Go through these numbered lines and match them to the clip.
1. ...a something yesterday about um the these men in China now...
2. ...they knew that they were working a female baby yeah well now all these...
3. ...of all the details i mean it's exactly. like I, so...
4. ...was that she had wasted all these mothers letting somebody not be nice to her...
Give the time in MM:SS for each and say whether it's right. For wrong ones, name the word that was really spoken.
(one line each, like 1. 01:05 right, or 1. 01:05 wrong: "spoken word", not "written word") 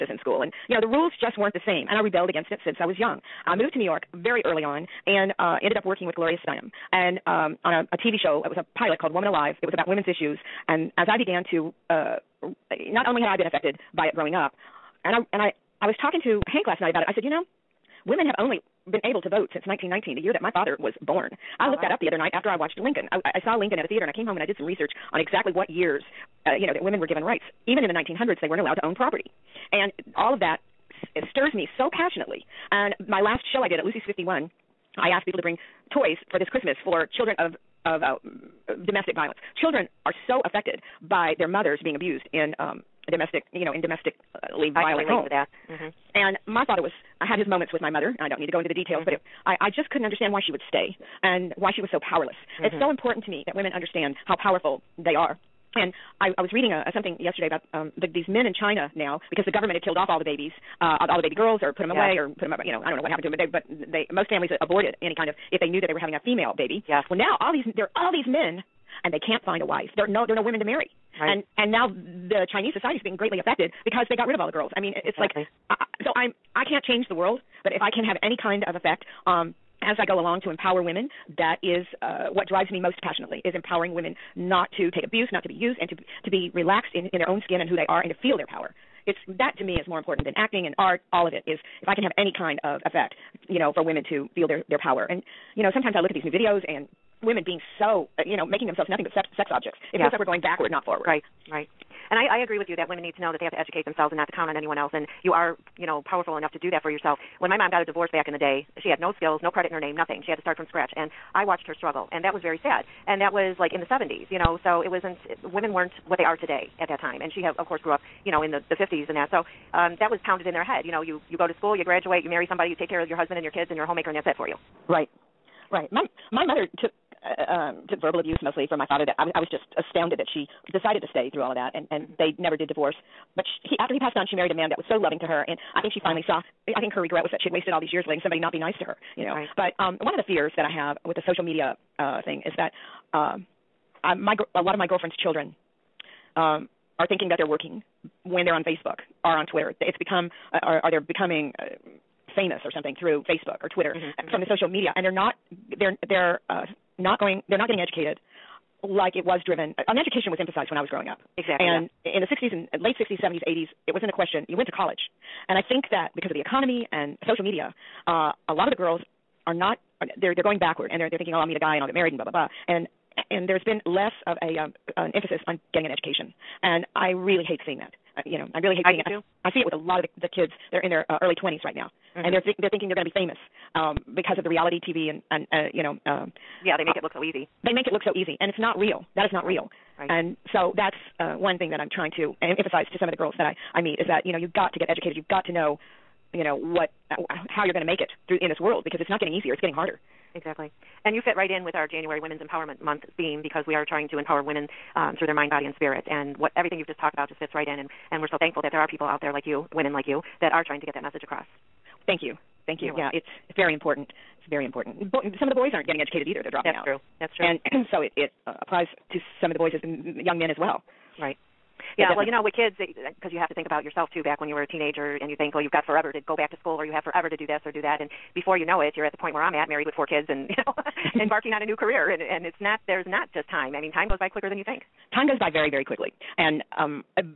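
1. 00:56 right
2. 01:05 wrong: "having", not "working"
3. 01:14 wrong: "girls", not "details"
4. 02:17 wrong: "years", not "mothers".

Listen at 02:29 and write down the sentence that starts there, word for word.
It's become uh, are are they're becoming uh, famous or something through Facebook or Twitter mm-hmm, uh, mm-hmm.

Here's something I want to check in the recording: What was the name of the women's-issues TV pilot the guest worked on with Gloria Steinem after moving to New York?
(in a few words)
Woman Alive.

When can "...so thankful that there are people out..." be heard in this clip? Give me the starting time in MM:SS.
03:28.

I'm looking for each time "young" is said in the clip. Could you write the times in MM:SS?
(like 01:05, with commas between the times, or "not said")
00:02, 03:39.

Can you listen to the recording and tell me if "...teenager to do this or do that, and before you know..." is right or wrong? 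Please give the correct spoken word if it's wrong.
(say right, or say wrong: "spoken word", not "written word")
wrong: "forever", not "teenager".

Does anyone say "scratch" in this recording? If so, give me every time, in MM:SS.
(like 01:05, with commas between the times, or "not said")
01:50.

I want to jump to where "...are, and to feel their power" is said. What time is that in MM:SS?
01:27.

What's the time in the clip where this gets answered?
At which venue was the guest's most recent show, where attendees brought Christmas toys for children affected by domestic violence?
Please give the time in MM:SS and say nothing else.
00:33.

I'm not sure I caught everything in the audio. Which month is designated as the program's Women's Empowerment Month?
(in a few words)
January.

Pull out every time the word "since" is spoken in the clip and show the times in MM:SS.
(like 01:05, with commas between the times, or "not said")
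00:02, 00:19.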